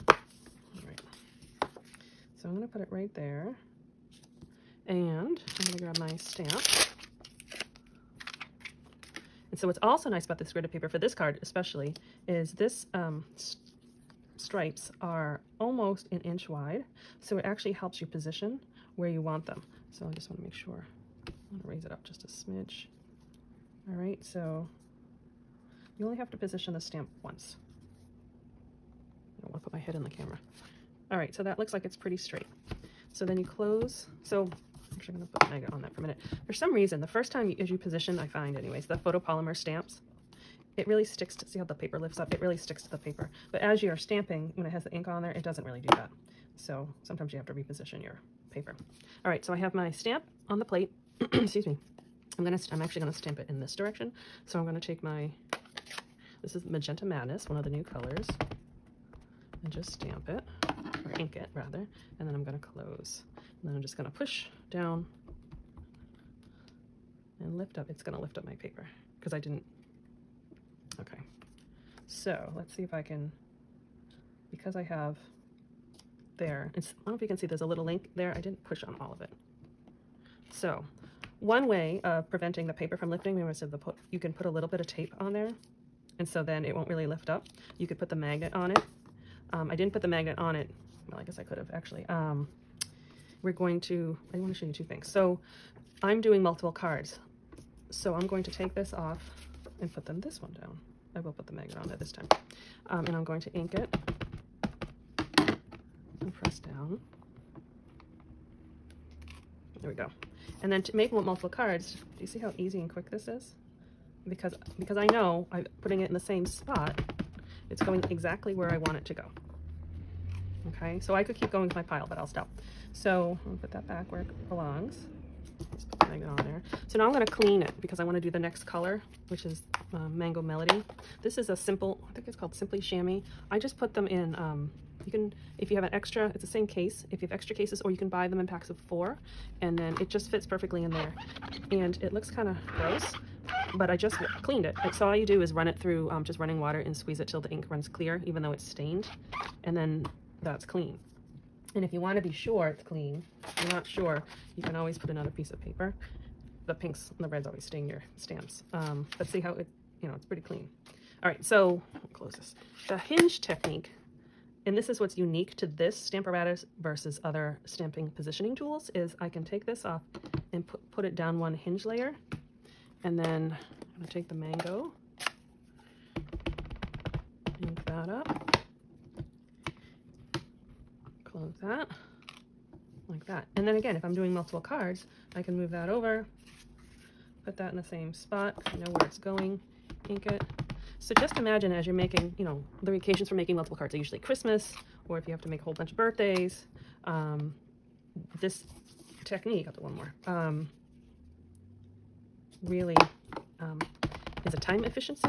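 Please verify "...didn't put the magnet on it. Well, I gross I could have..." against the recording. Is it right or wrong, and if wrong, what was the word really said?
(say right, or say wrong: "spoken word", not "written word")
wrong: "guess", not "gross".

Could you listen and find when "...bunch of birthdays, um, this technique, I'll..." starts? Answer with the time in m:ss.
3:15.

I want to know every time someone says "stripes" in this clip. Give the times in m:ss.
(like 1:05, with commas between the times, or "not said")
0:14.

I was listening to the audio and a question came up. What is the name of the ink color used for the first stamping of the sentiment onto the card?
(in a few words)
Magenta Madness.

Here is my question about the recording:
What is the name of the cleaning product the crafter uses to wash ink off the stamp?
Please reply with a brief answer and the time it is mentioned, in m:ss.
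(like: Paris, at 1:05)
Simply Shammy, at 2:12.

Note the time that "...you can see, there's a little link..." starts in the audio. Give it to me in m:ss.
1:17.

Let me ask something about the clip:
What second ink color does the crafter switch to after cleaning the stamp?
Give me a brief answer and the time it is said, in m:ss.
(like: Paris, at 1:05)
Mango Melody, at 2:10.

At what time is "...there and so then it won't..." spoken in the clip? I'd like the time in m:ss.
1:25.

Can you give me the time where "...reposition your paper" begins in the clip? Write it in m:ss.
0:47.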